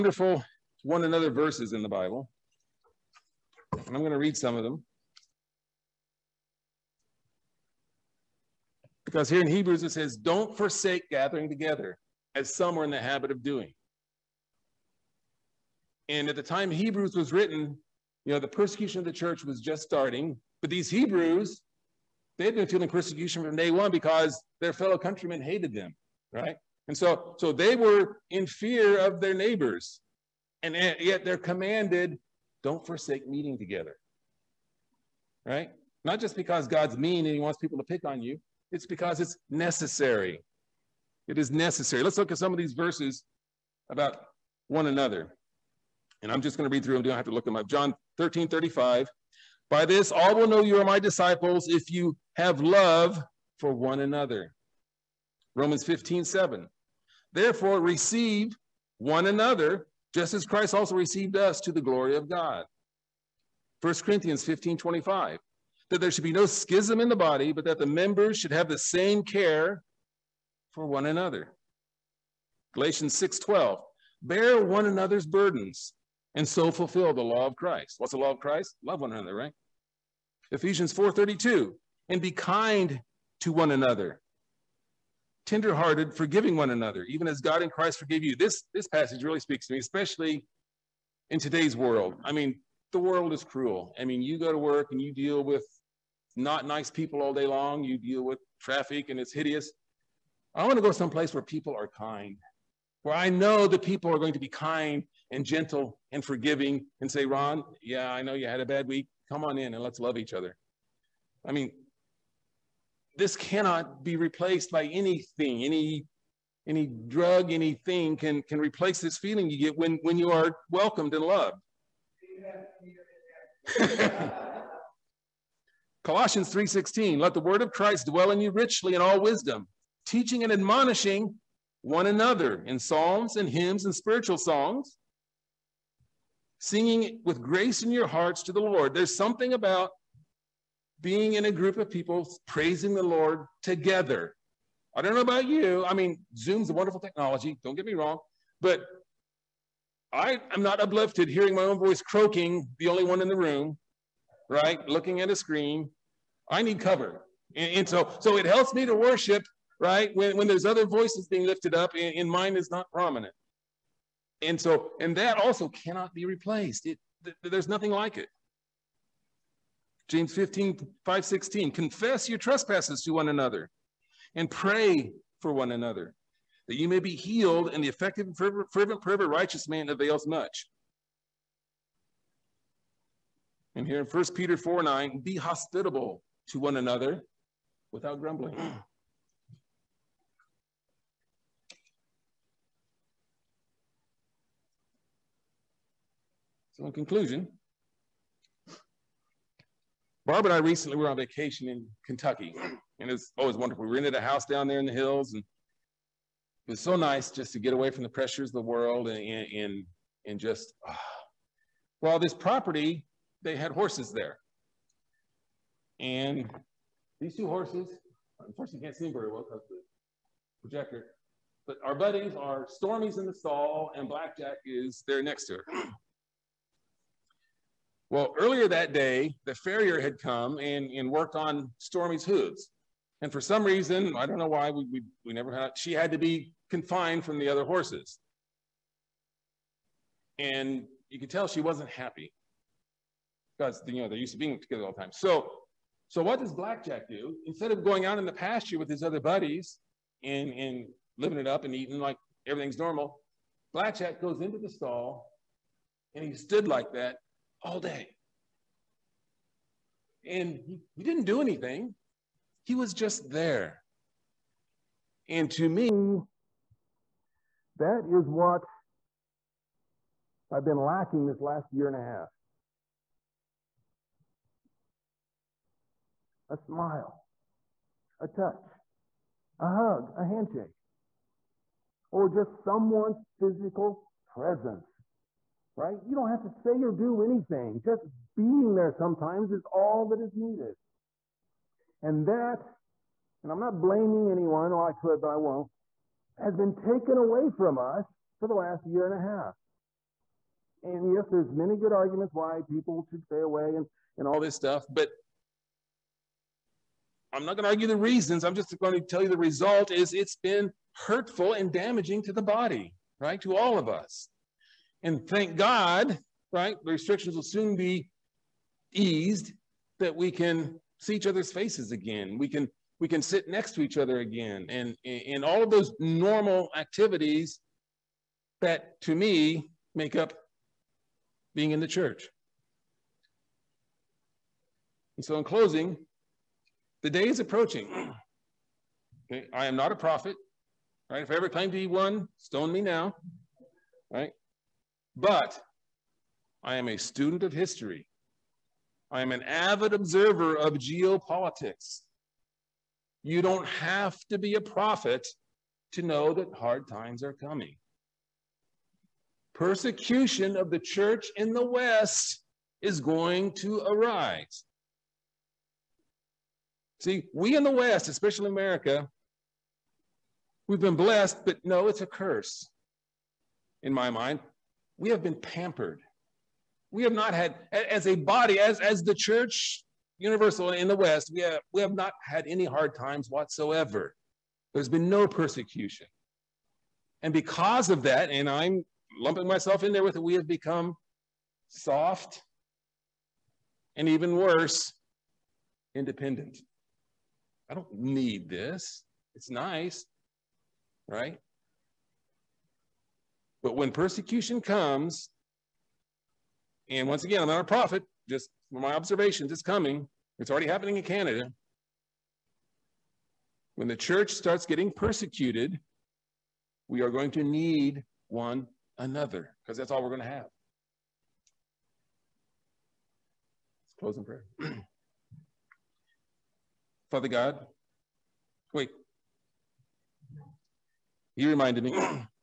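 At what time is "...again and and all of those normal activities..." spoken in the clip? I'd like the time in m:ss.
5:24.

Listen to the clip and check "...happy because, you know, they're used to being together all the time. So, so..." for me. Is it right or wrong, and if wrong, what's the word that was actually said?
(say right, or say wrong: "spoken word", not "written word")
right.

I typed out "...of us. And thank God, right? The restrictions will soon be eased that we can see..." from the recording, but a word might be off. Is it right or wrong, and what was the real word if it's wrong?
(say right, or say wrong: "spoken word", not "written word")
right.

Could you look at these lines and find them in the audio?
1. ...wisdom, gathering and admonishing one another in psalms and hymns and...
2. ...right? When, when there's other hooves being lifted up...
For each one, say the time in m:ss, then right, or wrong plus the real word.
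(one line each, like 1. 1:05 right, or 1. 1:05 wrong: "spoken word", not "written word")
1. 2:09 wrong: "teaching", not "gathering"
2. 2:39 wrong: "voices", not "hooves".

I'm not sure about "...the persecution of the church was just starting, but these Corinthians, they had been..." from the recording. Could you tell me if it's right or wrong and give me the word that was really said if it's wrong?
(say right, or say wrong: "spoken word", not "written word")
wrong: "Hebrews", not "Corinthians".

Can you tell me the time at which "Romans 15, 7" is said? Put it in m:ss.
0:55.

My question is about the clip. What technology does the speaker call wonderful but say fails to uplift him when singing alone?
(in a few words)
Zoom.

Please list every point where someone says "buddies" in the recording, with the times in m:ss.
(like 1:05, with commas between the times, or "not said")
3:41, 4:09.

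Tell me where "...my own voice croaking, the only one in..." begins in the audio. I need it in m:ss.
2:31.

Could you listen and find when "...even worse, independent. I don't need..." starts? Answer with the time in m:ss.
6:34.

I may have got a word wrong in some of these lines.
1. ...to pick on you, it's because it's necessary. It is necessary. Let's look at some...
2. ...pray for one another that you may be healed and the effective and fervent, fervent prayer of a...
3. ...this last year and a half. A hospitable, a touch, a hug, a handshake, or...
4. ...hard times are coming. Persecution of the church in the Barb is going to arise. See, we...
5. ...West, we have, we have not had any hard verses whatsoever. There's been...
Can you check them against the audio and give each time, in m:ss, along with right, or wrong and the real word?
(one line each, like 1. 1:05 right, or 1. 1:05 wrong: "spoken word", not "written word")
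1. 0:37 right
2. 2:54 right
3. 4:31 wrong: "smile", not "hospitable"
4. 5:56 wrong: "West", not "Barb"
5. 6:20 wrong: "times", not "verses".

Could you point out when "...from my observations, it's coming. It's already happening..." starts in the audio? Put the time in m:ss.
6:48.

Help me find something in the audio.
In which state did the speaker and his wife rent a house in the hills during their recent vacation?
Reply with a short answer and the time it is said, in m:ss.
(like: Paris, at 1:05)
Kentucky, at 3:22.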